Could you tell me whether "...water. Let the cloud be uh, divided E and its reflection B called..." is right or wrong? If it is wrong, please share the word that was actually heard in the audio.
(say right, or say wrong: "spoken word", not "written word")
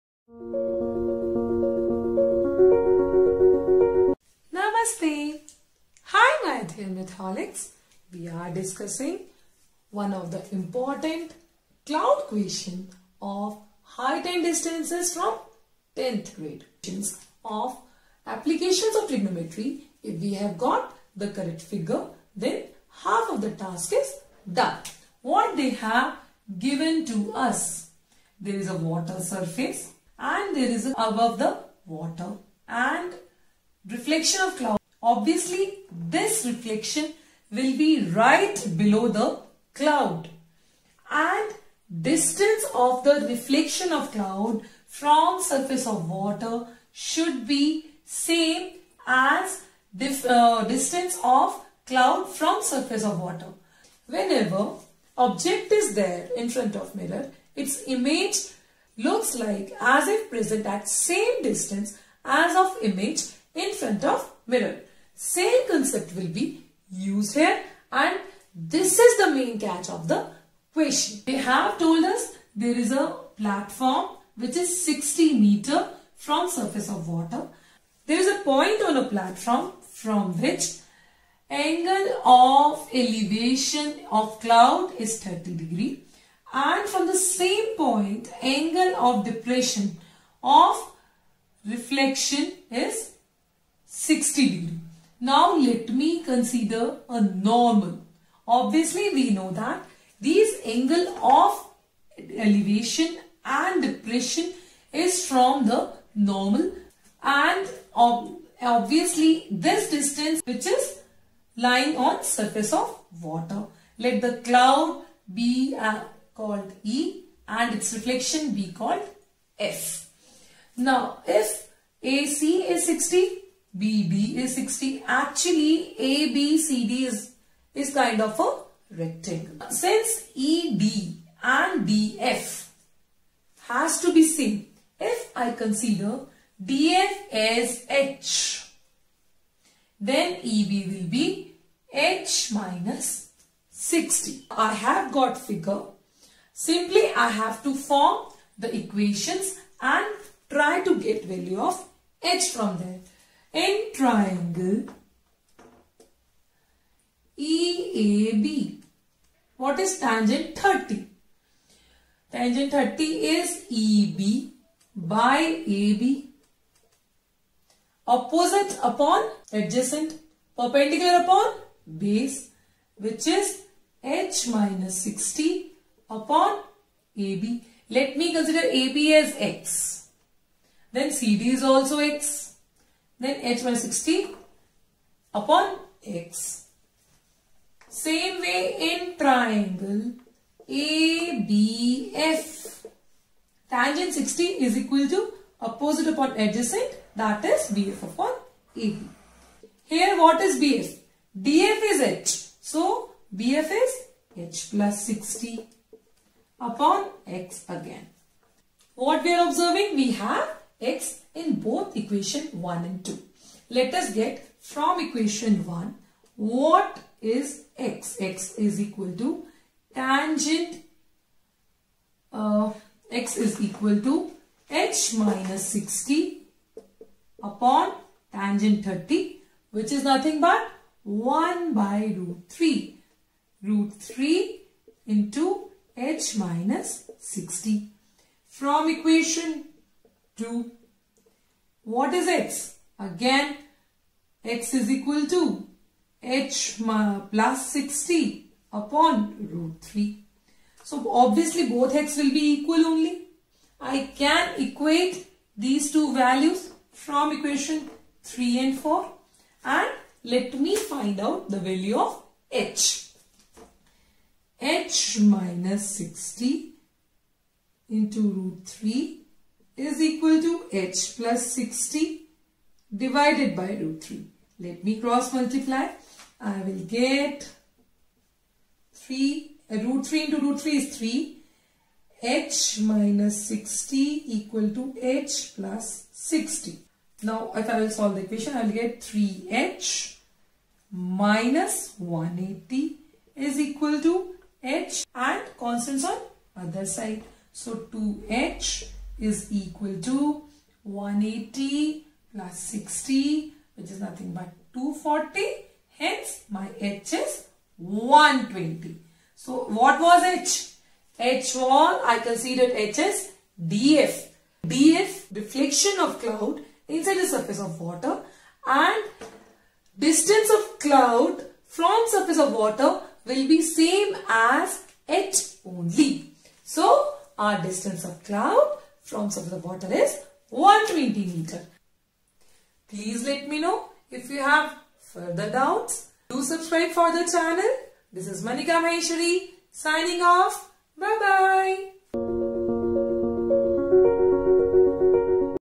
wrong: "called", not "divided".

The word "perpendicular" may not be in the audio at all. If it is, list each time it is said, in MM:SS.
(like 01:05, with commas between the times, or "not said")
02:50.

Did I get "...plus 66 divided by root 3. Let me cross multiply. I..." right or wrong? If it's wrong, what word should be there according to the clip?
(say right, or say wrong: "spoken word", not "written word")
wrong: "60", not "66".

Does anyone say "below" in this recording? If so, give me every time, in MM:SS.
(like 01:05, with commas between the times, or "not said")
00:38.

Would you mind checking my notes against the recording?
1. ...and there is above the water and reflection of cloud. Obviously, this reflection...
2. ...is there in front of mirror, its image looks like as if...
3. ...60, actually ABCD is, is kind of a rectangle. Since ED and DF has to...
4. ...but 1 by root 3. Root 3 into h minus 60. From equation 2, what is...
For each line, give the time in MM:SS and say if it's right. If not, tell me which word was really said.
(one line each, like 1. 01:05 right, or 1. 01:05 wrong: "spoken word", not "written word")
1. 00:30 right
2. 00:55 right
3. 02:04 right
4. 03:50 right.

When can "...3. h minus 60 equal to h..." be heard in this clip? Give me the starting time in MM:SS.
04:40.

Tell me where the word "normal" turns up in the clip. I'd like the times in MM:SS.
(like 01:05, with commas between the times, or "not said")
01:37, 01:46.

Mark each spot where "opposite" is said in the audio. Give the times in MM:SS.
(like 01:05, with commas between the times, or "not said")
02:48, 03:15.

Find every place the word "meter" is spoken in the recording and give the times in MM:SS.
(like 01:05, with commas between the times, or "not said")
01:15, 05:31.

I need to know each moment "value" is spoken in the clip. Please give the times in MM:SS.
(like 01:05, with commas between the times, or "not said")
02:31, 04:16, 04:21.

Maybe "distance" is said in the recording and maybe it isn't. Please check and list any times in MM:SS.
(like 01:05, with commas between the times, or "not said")
00:14, 00:42, 00:50, 01:01, 01:49, 05:19, 05:27.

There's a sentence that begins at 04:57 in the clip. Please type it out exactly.
So 2H is equal to 180 plus 60 which is nothing but 240 hence my H is 120.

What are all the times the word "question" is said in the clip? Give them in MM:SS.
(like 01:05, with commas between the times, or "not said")
00:12, 01:10.